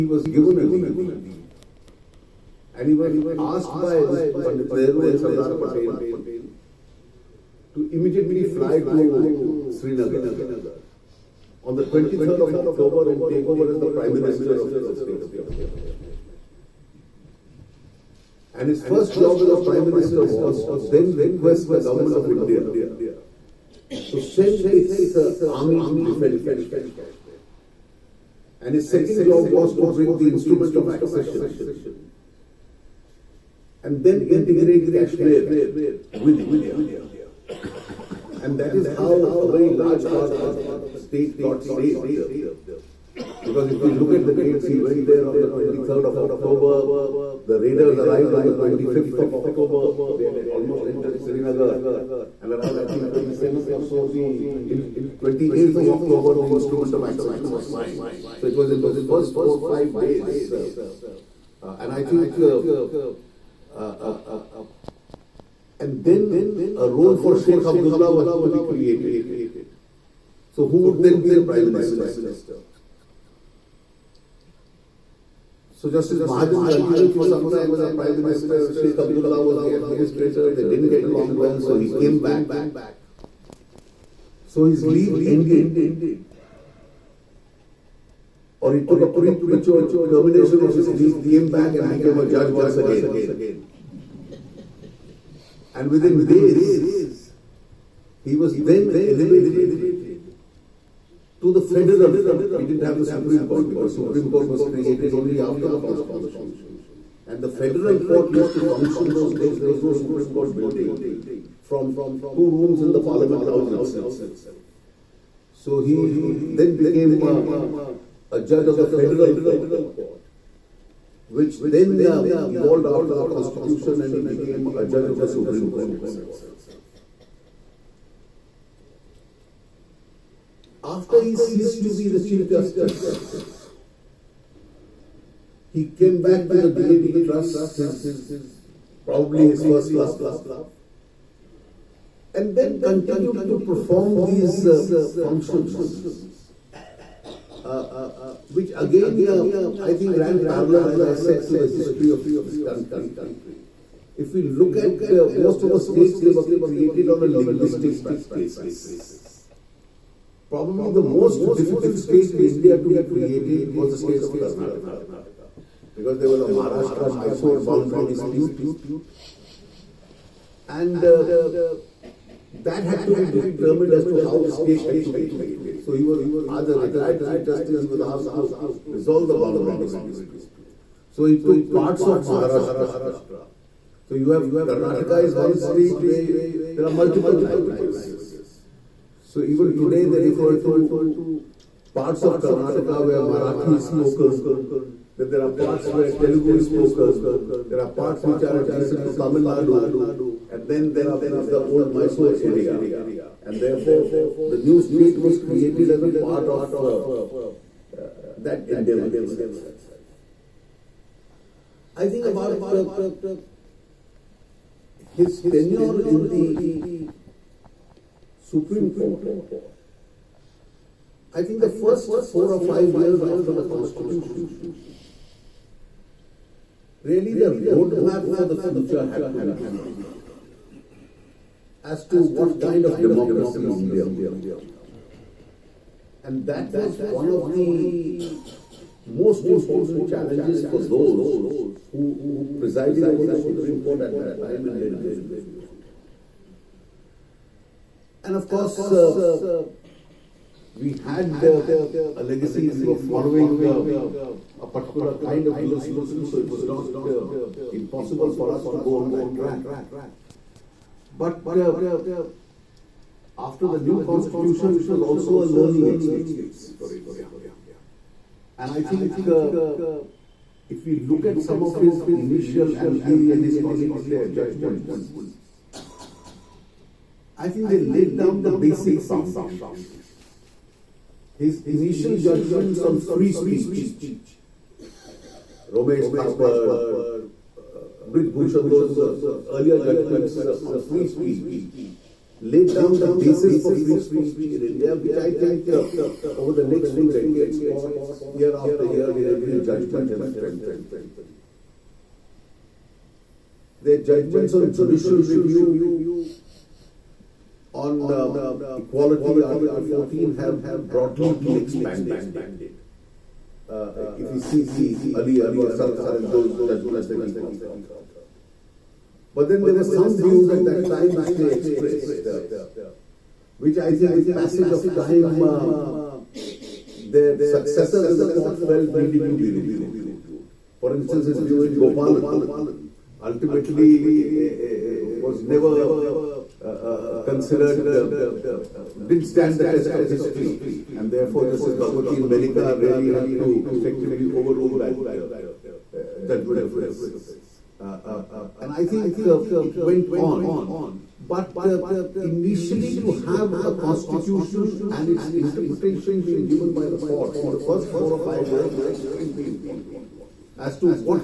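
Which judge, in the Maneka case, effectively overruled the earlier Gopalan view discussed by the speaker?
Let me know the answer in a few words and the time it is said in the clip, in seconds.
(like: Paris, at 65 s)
Justice Bhagwati, at 341 s.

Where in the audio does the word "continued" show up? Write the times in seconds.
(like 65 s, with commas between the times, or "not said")
76 s, 142 s.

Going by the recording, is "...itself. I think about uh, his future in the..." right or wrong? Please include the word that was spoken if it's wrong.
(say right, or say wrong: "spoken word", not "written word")
wrong: "tenure", not "future".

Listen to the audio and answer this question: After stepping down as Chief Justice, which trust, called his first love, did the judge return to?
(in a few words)
DAV Trust.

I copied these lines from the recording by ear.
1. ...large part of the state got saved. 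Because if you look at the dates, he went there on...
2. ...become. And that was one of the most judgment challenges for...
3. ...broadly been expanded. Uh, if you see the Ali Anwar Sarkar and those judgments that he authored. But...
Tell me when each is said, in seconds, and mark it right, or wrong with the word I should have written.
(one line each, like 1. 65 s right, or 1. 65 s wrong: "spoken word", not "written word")
1. 39 s right
2. 234 s wrong: "important", not "judgment"
3. 310 s right.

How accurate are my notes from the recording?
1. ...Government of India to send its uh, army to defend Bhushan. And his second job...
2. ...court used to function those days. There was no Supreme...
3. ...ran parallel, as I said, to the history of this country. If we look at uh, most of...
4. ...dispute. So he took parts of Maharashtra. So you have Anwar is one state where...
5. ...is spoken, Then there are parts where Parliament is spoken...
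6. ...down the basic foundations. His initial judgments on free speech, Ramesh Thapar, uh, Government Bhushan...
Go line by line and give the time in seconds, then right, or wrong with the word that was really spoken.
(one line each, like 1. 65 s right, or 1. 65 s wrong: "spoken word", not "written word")
1. 21 s wrong: "Kashmir", not "Bhushan"
2. 107 s right
3. 150 s right
4. 179 s wrong: "Karnataka", not "Anwar"
5. 193 s wrong: "Telugu", not "Parliament"
6. 278 s wrong: "Brij", not "Government".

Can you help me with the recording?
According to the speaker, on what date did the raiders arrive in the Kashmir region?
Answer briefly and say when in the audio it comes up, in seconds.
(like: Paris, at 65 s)
25th of October, at 48 s.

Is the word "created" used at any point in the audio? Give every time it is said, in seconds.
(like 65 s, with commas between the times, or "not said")
68 s, 104 s, 156 s, 163 s, 175 s, 205 s.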